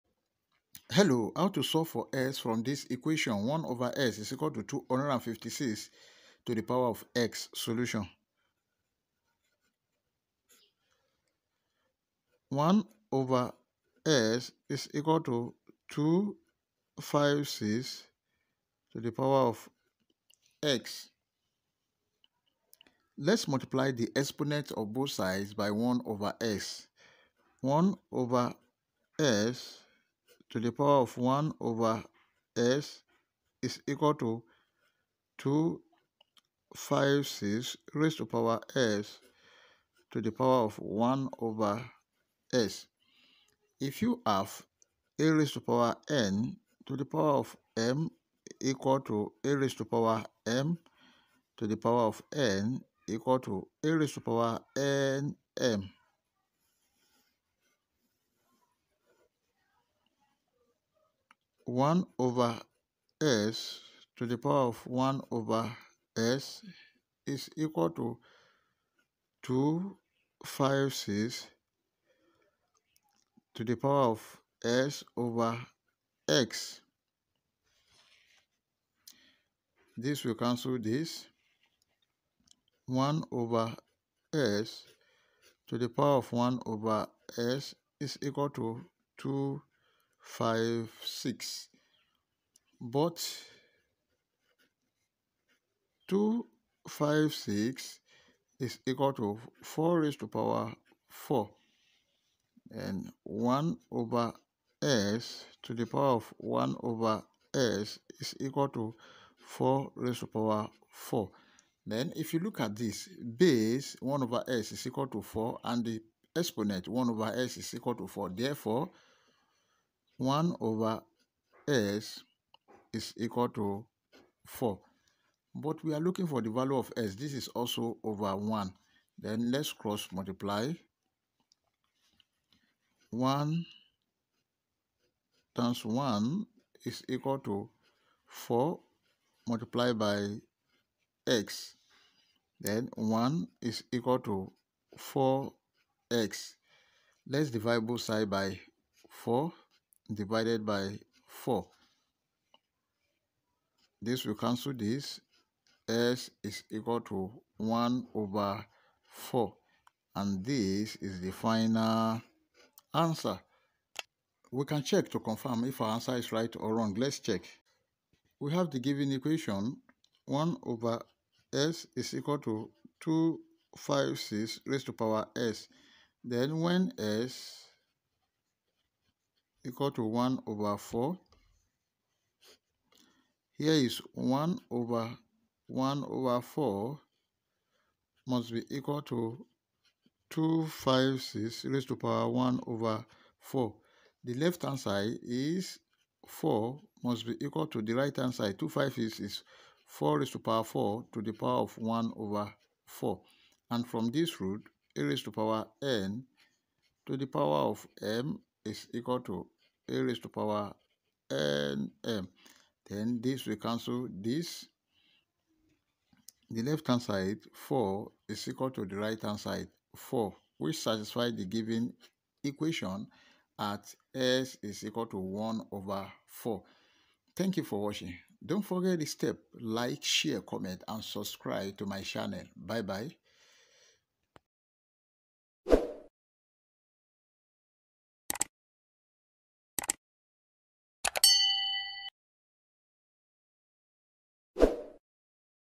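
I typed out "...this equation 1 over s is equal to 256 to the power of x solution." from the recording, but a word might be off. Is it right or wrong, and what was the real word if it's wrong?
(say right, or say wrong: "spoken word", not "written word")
right.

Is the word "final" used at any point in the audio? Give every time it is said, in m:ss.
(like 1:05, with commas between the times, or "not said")
2:41.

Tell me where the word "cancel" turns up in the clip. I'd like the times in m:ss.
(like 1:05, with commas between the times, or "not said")
1:20, 2:34, 3:33.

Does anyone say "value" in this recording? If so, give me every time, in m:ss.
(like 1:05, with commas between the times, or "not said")
2:06.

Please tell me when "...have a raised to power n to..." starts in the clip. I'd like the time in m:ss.
0:44.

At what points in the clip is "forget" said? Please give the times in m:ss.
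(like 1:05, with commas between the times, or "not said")
3:48.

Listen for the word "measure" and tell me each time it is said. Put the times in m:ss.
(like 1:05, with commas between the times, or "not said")
not said.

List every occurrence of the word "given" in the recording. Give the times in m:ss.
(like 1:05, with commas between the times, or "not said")
2:48, 3:41.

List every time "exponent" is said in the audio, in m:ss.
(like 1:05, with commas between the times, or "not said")
0:24, 1:56.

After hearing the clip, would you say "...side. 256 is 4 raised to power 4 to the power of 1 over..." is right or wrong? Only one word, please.
right.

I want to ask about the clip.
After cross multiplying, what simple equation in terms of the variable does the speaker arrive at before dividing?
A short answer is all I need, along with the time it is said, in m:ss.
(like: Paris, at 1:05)
1 = 4x, at 2:22.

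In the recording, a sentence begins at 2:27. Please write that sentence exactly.
Let's divide both sides by 4 divided by 4.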